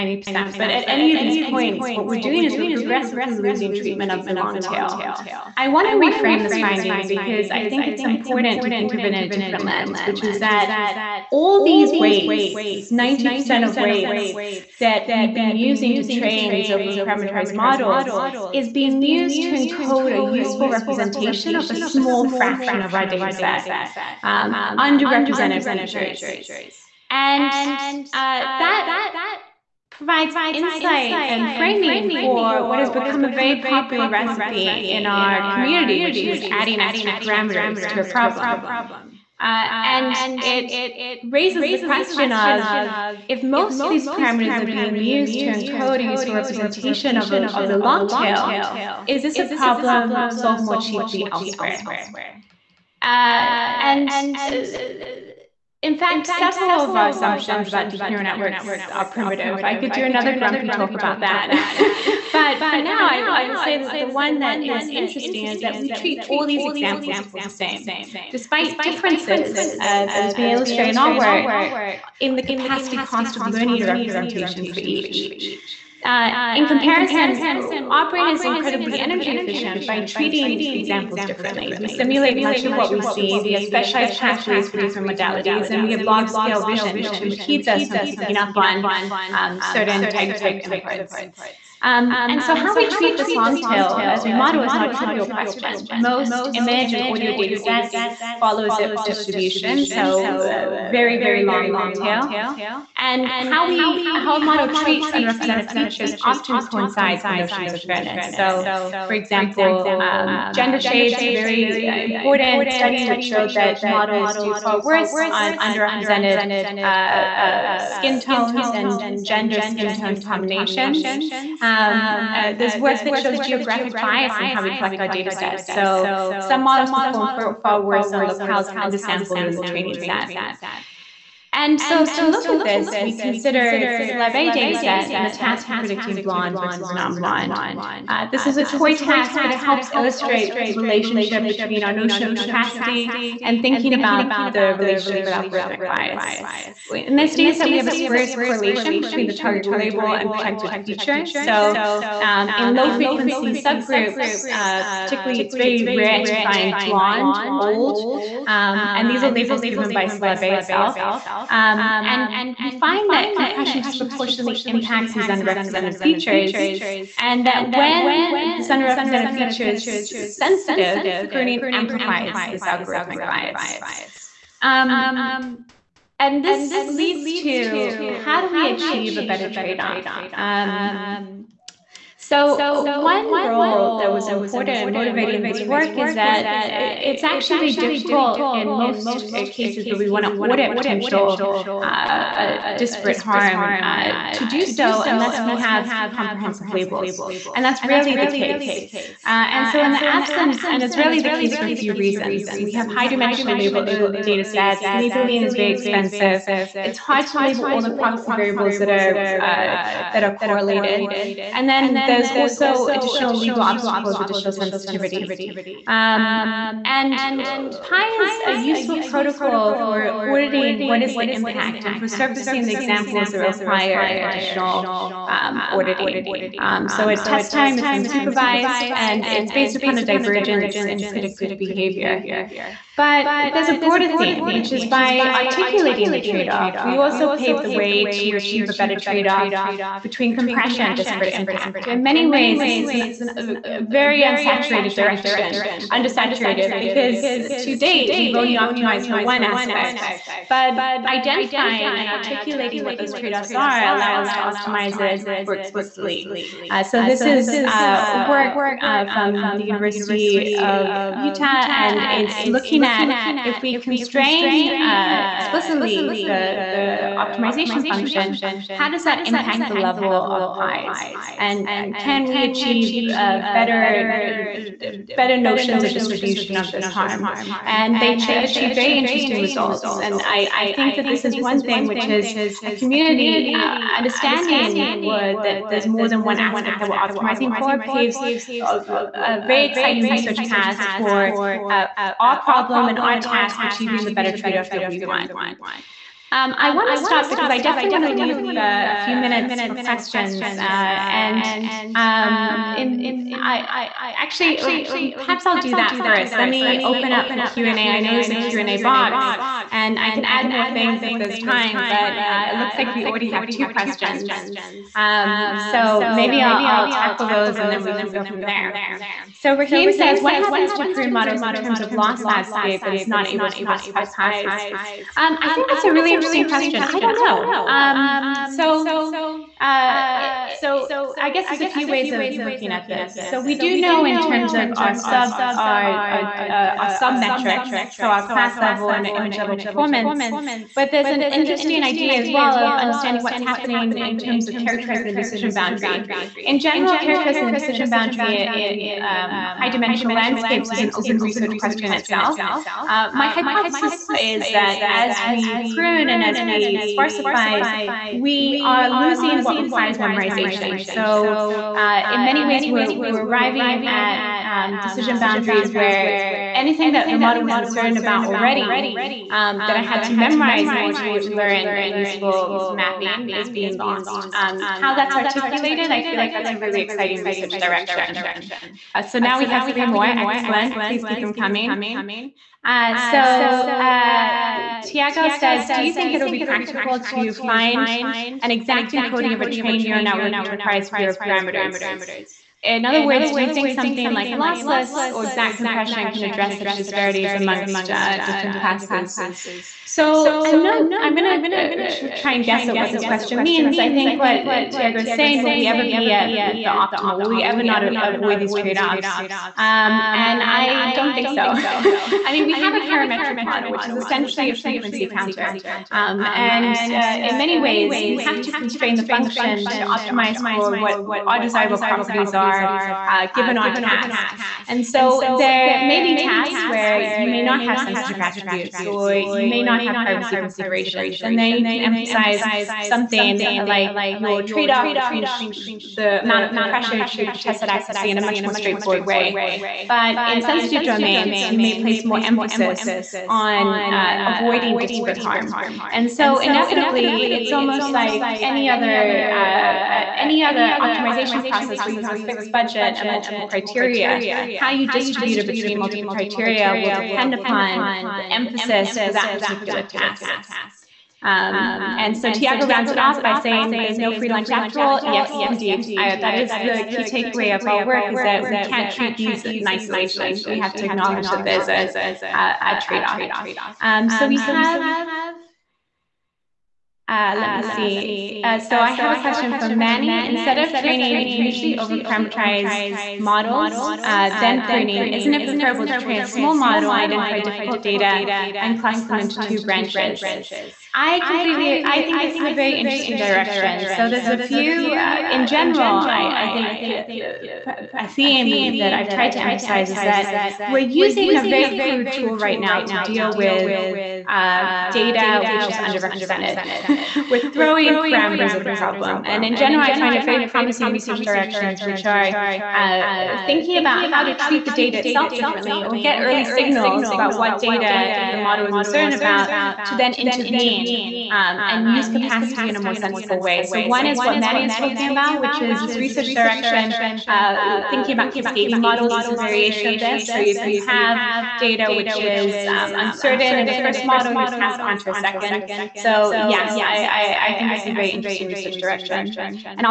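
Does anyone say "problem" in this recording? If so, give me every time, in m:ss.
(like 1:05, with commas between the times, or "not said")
0:38, 0:49, 4:52, 8:28.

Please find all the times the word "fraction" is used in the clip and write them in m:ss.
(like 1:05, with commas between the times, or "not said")
0:22.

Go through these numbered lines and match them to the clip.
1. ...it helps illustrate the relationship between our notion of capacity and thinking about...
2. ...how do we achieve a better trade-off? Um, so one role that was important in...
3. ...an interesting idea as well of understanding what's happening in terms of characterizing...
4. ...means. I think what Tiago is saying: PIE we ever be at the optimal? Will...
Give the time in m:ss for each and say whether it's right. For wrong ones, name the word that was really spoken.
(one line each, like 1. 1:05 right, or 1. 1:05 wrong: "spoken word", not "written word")
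1. 2:19 right
2. 2:58 right
3. 5:41 right
4. 6:43 wrong: "Will", not "PIE".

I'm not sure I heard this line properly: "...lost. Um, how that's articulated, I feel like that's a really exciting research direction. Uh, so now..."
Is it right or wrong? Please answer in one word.
right.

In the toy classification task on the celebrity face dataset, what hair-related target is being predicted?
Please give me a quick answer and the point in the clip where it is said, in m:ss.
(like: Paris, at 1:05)
blonde versus non-blonde, at 2:16.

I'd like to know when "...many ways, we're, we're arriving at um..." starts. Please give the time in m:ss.
6:02.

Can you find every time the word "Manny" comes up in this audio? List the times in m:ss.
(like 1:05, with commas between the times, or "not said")
7:59, 8:44.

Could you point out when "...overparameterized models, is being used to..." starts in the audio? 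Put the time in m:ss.
0:16.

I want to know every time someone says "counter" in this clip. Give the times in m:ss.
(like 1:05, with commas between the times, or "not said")
6:55.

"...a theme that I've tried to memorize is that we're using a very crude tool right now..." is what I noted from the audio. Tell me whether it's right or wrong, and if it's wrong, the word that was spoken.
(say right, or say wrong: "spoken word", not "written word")
wrong: "emphasize", not "memorize".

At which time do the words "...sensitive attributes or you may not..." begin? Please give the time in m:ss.
7:07.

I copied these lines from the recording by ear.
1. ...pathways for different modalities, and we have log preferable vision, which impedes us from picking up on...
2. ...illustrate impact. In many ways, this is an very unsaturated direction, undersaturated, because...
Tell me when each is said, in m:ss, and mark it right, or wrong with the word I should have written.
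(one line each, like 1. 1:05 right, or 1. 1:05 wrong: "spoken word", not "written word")
1. 1:24 wrong: "scale", not "preferable"
2. 4:00 wrong: "disparate", not "illustrate".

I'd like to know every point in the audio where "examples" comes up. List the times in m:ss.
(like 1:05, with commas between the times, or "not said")
1:06, 1:20, 1:49, 3:42.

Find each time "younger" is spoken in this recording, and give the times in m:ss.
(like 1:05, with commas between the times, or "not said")
not said.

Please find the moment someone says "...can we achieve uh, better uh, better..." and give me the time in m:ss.
4:32.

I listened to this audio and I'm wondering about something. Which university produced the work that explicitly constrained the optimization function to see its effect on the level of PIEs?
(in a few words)
University of Utah.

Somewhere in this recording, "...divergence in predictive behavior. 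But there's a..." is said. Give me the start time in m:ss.
3:50.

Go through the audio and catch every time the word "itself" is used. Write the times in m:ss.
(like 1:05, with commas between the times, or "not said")
2:40, 5:51, 8:35.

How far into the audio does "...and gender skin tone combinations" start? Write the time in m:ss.
1:58.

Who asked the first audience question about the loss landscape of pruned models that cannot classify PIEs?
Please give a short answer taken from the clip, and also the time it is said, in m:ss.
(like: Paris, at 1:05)
Raheem, at 5:19.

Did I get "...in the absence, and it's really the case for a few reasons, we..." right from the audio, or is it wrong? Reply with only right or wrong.
right.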